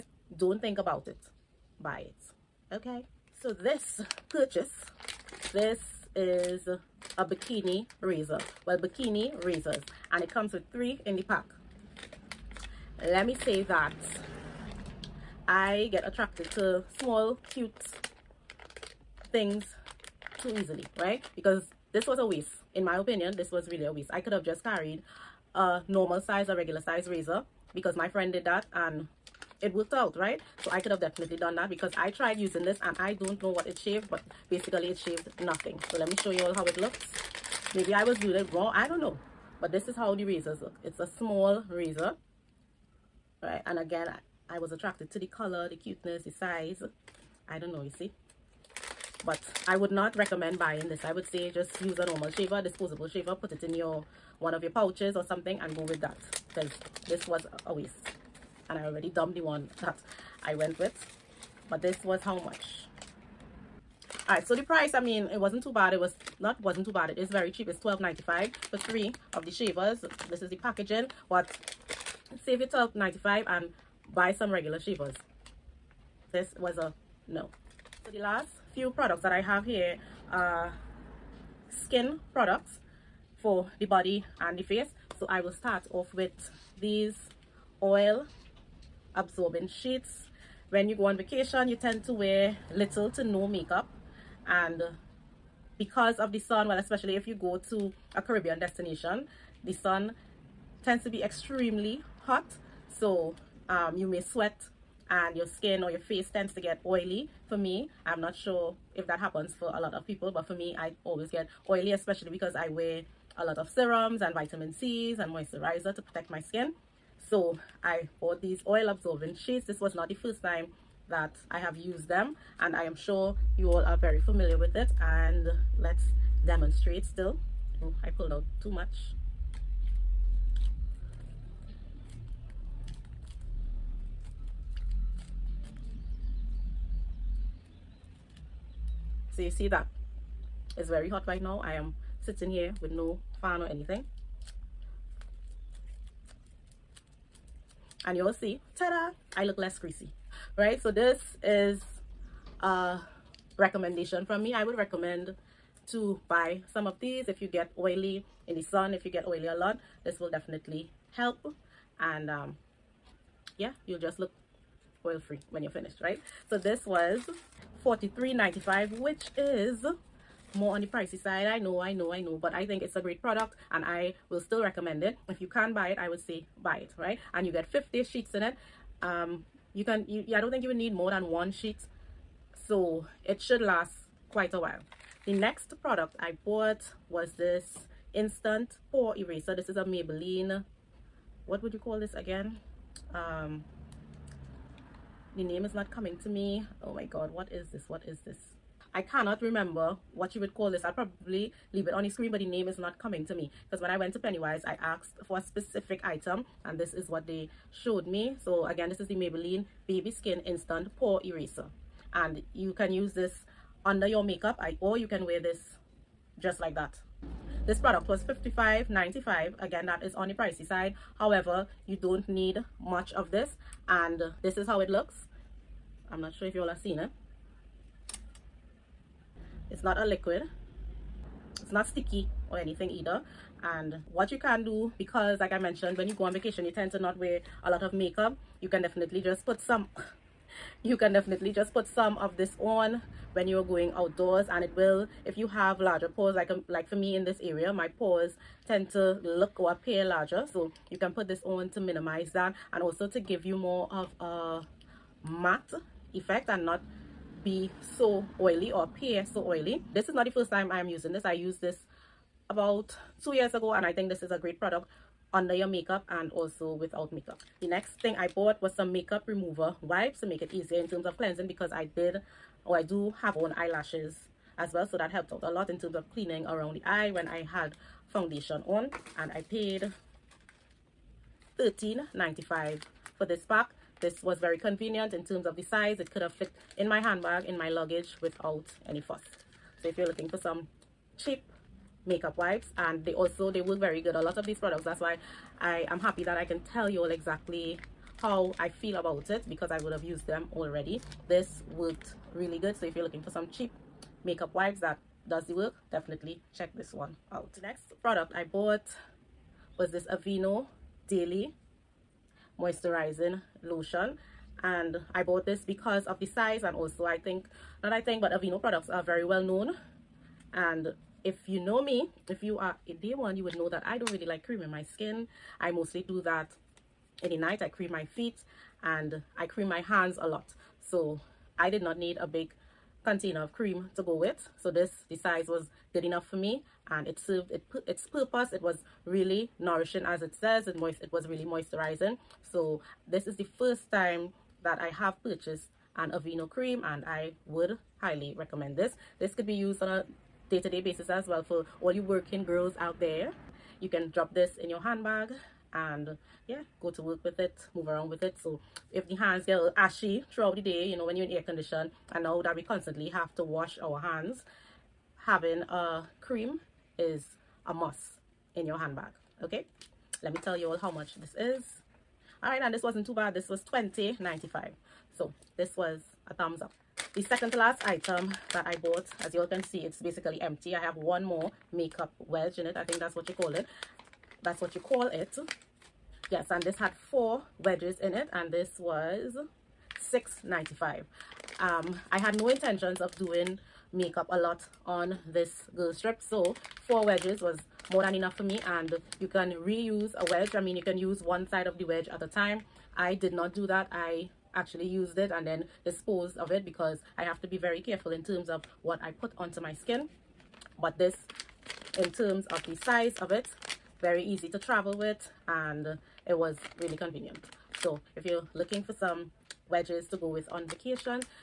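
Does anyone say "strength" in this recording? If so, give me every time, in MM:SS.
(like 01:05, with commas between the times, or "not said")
not said.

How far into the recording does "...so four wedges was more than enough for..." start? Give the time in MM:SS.
06:36.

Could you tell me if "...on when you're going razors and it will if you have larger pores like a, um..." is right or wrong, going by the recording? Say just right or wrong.
wrong.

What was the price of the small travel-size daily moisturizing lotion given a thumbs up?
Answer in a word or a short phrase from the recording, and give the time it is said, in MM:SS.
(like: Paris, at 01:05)
20.95, at 06:13.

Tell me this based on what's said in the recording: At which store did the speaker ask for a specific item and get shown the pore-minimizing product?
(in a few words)
Pennywise.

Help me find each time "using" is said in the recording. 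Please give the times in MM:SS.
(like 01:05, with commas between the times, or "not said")
00:32, 04:20.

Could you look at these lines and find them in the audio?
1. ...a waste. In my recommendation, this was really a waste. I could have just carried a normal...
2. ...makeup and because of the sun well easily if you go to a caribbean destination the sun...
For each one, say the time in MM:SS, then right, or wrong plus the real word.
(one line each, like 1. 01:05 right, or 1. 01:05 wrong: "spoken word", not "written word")
1. 00:22 wrong: "opinion", not "recommendation"
2. 01:33 wrong: "especially", not "easily".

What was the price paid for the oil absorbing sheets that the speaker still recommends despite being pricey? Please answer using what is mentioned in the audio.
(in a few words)
43.95.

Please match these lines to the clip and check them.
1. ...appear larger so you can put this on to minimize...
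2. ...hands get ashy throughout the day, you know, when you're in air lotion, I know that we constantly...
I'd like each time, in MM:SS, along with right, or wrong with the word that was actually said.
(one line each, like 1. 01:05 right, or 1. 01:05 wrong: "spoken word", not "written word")
1. 04:09 right
2. 05:59 wrong: "condition", not "lotion".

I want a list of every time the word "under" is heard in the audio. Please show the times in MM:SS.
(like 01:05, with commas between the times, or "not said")
03:33, 04:25.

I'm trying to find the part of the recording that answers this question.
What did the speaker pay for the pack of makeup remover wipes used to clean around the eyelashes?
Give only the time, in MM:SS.
04:39.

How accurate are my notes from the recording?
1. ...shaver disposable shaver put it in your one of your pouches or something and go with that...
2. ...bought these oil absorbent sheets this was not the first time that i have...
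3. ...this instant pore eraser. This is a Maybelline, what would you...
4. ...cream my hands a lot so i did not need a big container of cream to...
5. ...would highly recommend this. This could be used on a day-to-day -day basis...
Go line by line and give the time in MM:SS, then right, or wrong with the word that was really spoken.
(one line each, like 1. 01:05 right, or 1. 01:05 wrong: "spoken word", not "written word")
1. 00:52 right
2. 01:58 right
3. 03:07 right
4. 05:29 right
5. 05:47 right.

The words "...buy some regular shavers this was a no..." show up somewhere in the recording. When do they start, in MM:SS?
01:14.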